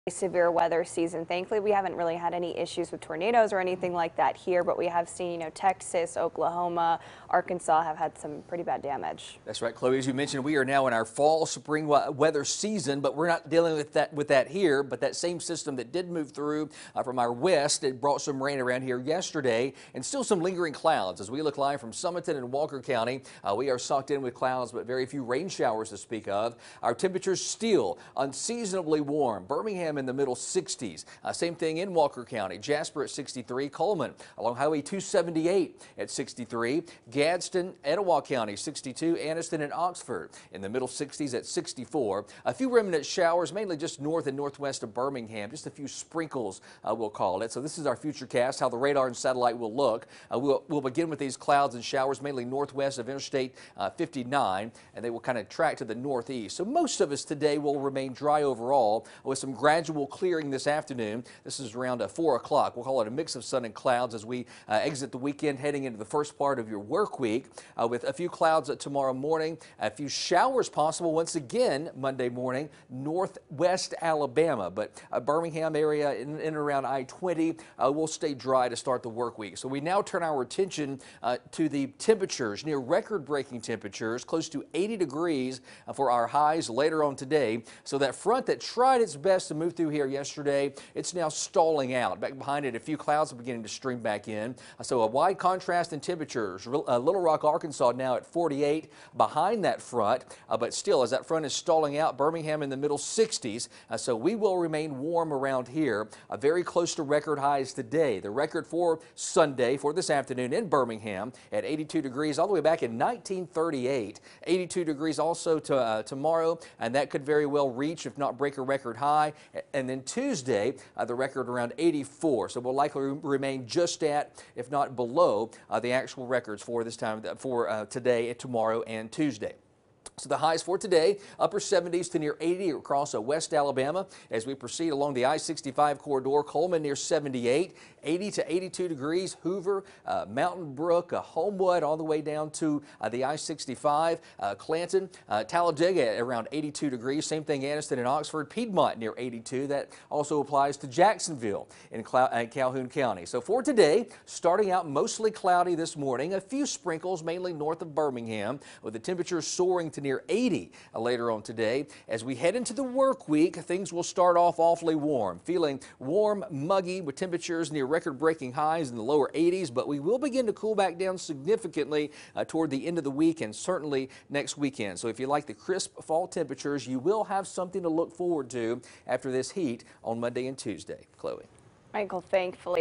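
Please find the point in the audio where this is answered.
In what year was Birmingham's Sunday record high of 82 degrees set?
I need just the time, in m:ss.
1:52.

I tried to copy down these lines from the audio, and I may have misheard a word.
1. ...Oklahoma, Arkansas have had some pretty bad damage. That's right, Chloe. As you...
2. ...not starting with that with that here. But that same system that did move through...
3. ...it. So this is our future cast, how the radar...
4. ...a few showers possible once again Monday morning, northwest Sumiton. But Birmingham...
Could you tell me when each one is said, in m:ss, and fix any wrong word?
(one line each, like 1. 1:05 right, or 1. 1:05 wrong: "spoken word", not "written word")
1. 0:06 right
2. 0:13 wrong: "dealing", not "starting"
3. 0:47 right
4. 1:09 wrong: "Alabama", not "Sumiton".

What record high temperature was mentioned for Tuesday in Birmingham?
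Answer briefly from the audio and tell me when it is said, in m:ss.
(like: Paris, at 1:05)
84, at 2:01.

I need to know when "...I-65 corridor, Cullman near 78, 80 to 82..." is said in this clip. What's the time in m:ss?
2:15.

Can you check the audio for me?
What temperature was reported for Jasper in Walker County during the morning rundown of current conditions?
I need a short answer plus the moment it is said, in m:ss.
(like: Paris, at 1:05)
63, at 0:32.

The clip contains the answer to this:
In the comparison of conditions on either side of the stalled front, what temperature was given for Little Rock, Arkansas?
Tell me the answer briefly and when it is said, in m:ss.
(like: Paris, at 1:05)
48, at 1:38.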